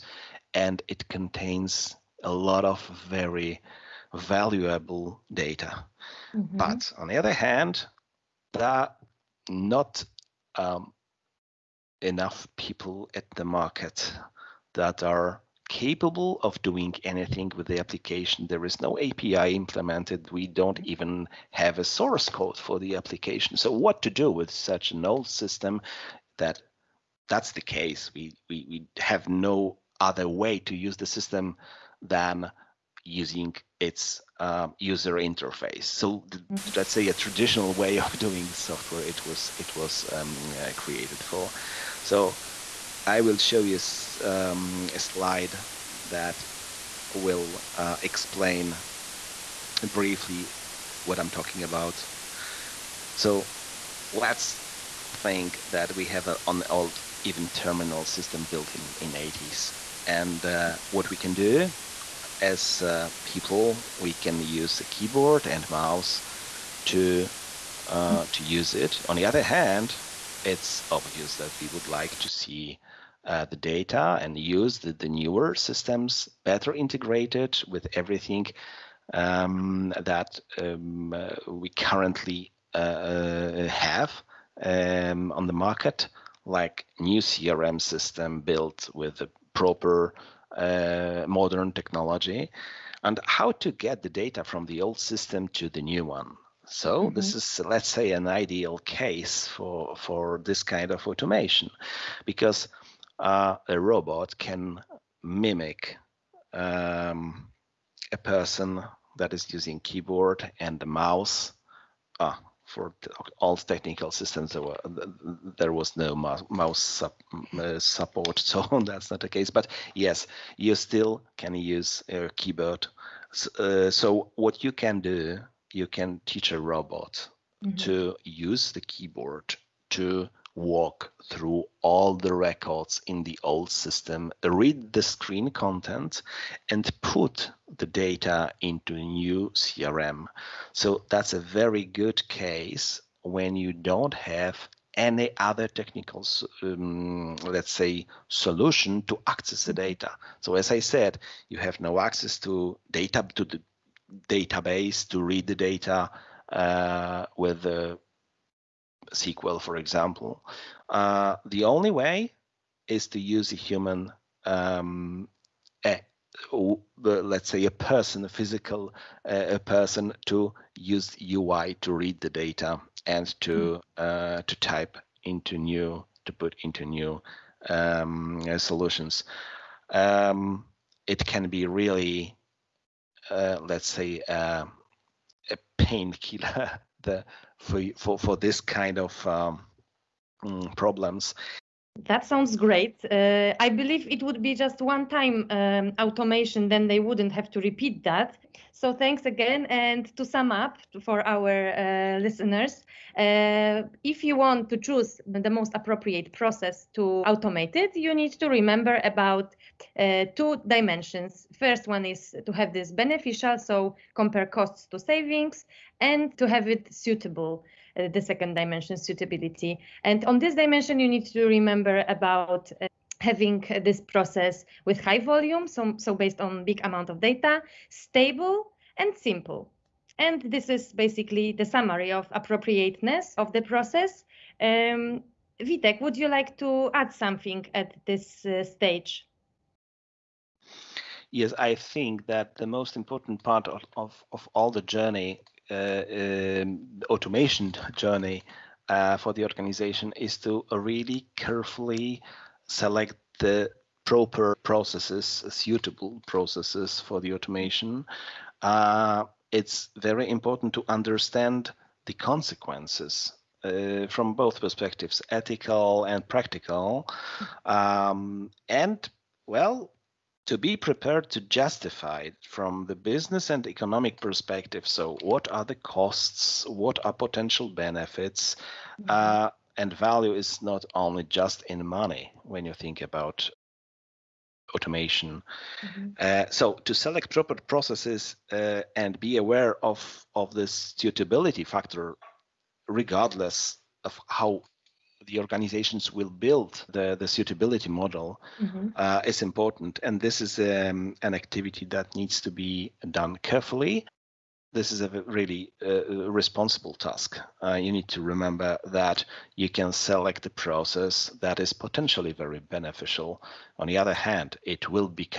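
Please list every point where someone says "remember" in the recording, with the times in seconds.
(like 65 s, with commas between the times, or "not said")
208 s, 221 s, 308 s.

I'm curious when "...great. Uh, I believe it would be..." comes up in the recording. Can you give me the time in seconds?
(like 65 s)
192 s.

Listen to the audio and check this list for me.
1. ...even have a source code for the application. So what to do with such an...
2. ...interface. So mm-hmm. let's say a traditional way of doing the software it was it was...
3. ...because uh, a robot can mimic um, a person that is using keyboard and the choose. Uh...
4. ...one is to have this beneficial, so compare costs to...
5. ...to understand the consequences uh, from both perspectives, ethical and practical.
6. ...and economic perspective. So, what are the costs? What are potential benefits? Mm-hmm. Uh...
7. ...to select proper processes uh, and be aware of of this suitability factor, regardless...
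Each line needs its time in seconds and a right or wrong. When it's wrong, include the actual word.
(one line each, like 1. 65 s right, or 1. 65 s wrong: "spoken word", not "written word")
1. 20 s right
2. 35 s right
3. 102 s wrong: "mouse", not "choose"
4. 211 s right
5. 260 s right
6. 273 s right
7. 286 s right.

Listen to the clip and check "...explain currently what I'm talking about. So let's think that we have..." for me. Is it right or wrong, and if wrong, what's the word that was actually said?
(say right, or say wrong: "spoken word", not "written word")
wrong: "briefly", not "currently".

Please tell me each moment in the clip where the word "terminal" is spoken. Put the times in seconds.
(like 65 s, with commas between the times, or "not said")
57 s.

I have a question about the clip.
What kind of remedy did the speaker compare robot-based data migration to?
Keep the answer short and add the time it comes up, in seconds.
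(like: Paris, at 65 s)
a painkiller, at 185 s.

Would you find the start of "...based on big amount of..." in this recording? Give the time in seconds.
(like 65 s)
226 s.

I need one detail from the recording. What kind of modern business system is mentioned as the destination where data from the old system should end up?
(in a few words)
CRM system.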